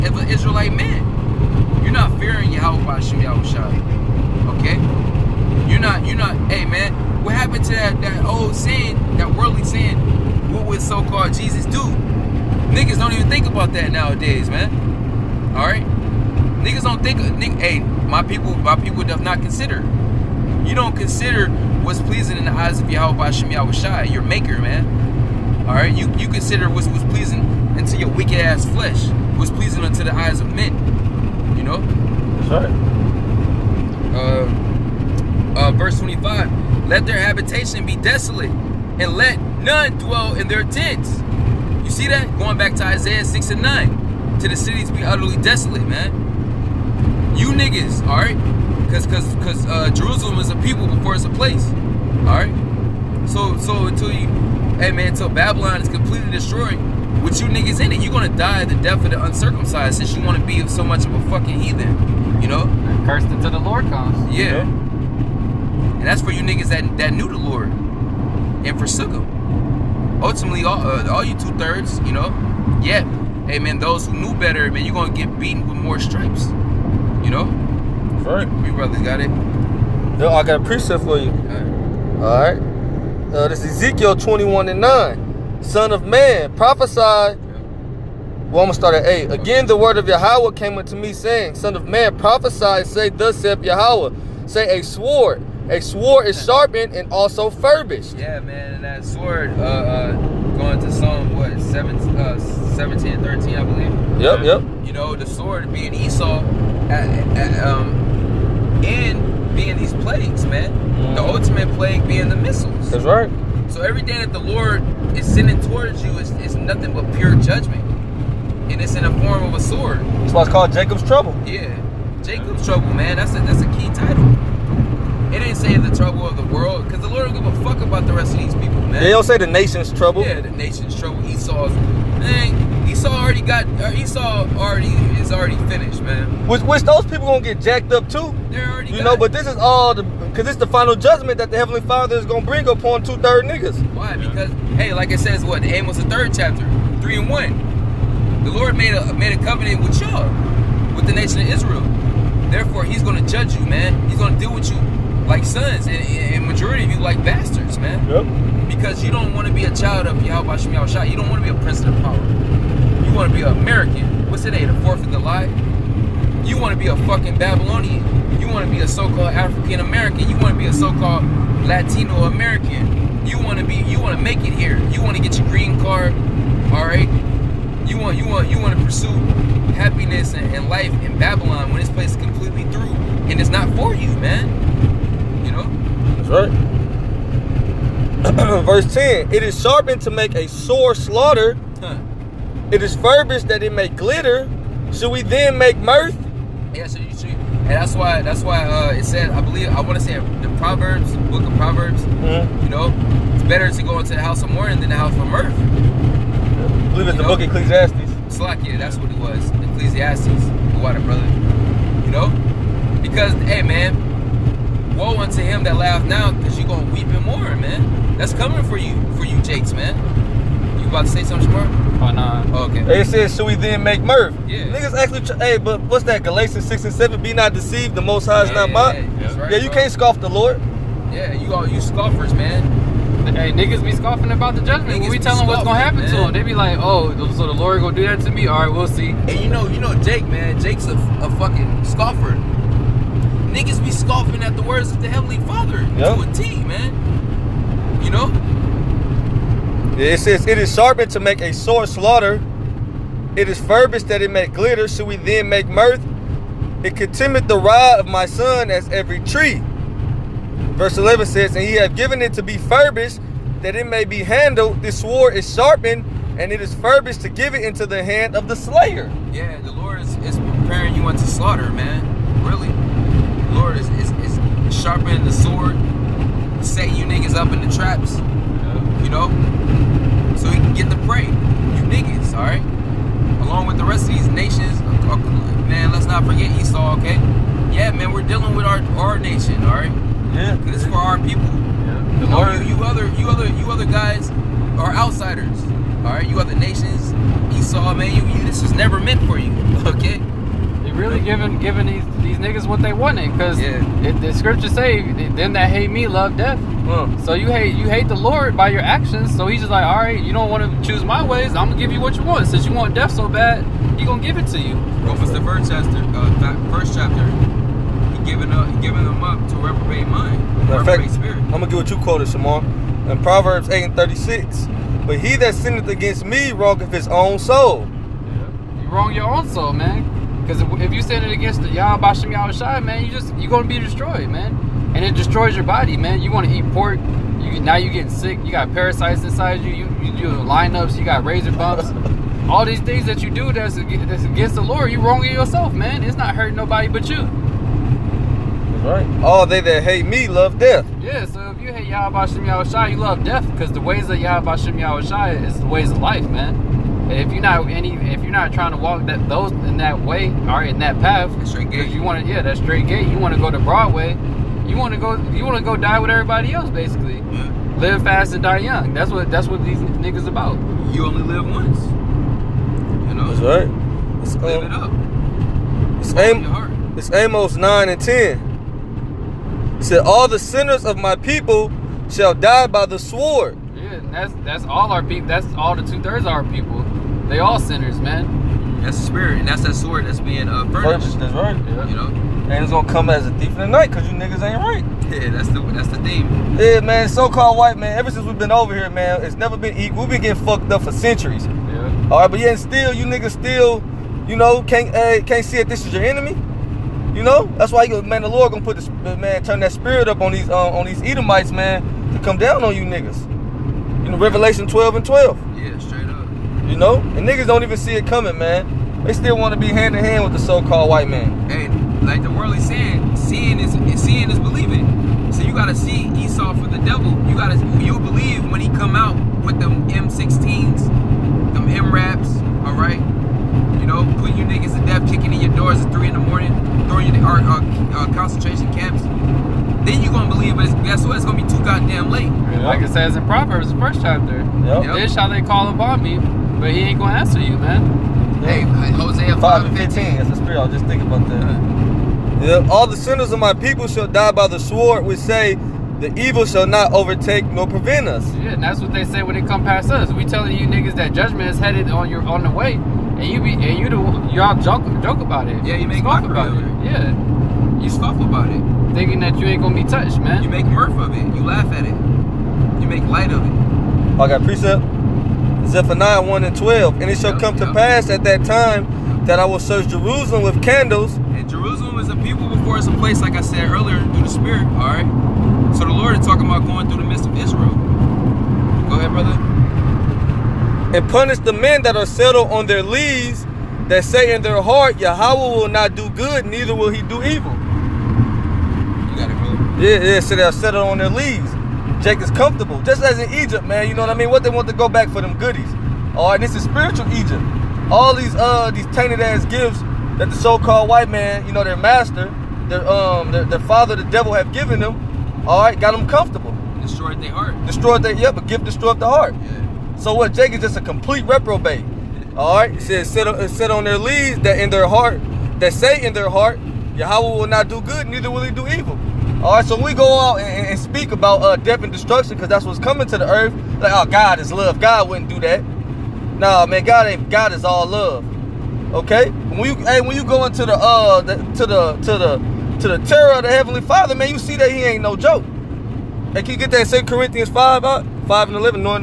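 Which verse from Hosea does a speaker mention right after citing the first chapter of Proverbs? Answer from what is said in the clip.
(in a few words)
Hosea 5:15.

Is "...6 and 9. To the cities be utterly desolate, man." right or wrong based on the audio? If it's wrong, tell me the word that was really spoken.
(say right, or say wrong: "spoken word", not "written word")
right.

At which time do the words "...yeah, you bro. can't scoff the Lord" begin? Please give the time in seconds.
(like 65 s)
229 s.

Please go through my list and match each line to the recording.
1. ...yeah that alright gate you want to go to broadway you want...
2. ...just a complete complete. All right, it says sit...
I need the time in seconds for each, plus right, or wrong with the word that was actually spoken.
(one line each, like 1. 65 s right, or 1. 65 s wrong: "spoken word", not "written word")
1. 362 s wrong: "straight", not "alright"
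2. 520 s wrong: "reprobate", not "complete".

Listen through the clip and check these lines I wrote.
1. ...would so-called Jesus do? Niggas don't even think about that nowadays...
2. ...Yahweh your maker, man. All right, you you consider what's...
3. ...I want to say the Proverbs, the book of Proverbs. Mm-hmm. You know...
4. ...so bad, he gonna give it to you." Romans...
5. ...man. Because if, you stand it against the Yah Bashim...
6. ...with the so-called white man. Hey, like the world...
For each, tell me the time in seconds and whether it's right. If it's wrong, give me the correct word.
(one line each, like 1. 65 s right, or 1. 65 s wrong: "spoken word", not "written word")
1. 10 s right
2. 23 s right
3. 199 s right
4. 313 s right
5. 329 s right
6. 420 s right.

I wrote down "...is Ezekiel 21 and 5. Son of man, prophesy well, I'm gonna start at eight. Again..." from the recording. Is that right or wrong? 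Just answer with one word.
wrong.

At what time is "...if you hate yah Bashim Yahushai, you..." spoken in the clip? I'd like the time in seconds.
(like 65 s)
351 s.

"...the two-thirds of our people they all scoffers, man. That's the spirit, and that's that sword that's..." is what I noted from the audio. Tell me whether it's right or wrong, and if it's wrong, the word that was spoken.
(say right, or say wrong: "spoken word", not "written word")
wrong: "sinners", not "scoffers".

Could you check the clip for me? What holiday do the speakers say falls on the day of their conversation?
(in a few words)
Fourth of July.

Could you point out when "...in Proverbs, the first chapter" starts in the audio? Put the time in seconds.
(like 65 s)
443 s.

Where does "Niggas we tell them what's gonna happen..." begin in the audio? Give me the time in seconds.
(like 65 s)
235 s.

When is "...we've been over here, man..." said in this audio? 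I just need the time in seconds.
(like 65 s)
398 s.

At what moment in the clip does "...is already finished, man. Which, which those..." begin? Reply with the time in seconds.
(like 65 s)
135 s.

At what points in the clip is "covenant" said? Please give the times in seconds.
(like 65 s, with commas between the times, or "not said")
149 s.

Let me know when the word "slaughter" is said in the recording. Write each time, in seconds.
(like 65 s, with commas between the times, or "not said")
190 s, 251 s, 271 s.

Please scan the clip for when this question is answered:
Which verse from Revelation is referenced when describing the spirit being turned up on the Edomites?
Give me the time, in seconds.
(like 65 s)
414 s.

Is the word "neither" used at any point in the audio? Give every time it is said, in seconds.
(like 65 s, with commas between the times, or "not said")
496 s, 528 s.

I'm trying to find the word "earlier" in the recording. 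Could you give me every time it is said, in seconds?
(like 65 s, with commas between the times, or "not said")
483 s.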